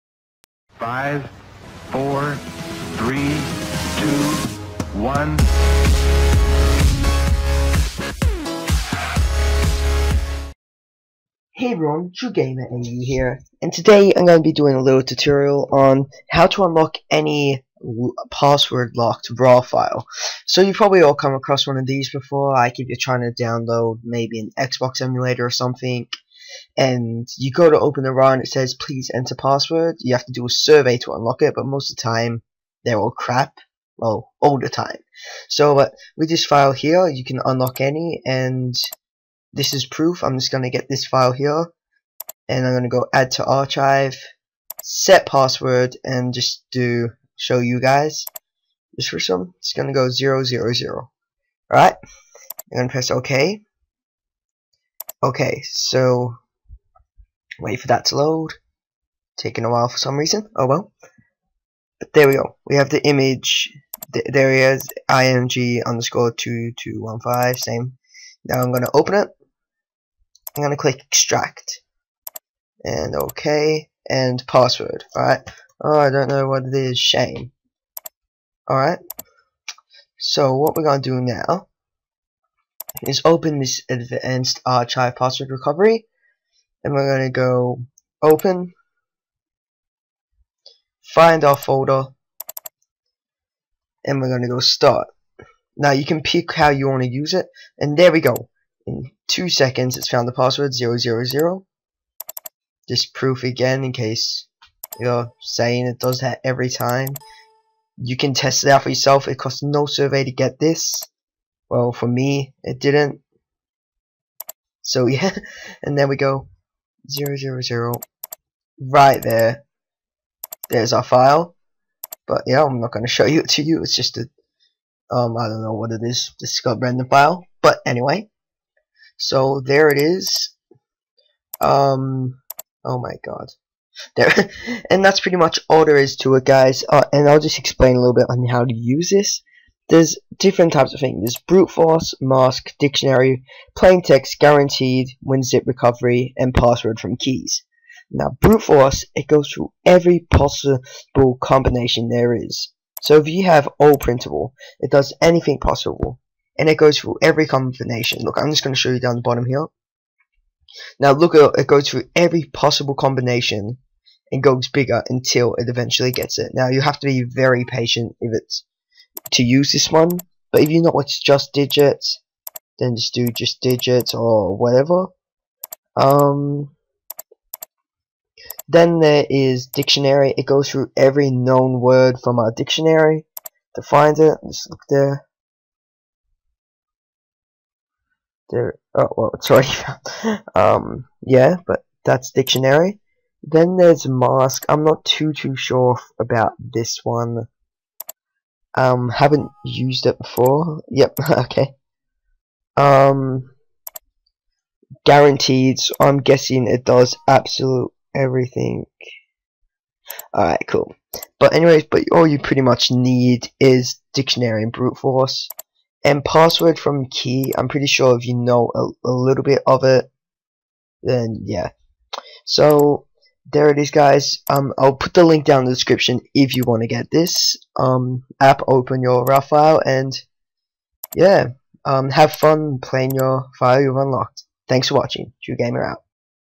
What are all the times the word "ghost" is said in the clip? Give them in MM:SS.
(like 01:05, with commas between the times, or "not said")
not said.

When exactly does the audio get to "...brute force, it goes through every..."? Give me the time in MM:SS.
02:28.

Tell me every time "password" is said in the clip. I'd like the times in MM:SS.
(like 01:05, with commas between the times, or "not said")
00:18, 00:29, 00:45, 01:14, 01:25, 01:40, 02:26, 03:36.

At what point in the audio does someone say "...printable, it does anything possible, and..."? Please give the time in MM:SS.
02:33.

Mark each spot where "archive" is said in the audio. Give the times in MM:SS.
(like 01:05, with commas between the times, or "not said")
00:43, 01:24.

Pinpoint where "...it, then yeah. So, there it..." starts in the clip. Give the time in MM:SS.
03:39.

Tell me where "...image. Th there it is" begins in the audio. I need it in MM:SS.
01:03.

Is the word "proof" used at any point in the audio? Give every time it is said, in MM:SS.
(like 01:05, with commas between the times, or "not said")
00:39, 01:43.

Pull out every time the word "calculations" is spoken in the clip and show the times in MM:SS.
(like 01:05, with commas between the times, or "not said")
not said.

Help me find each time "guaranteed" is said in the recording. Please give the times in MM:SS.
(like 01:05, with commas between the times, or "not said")
02:24, 03:25.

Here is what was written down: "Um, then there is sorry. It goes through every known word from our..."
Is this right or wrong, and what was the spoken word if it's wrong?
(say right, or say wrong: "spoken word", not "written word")
wrong: "dictionary", not "sorry".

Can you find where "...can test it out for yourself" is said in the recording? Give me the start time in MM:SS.
01:48.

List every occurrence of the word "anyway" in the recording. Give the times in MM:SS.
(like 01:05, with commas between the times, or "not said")
02:07, 03:31.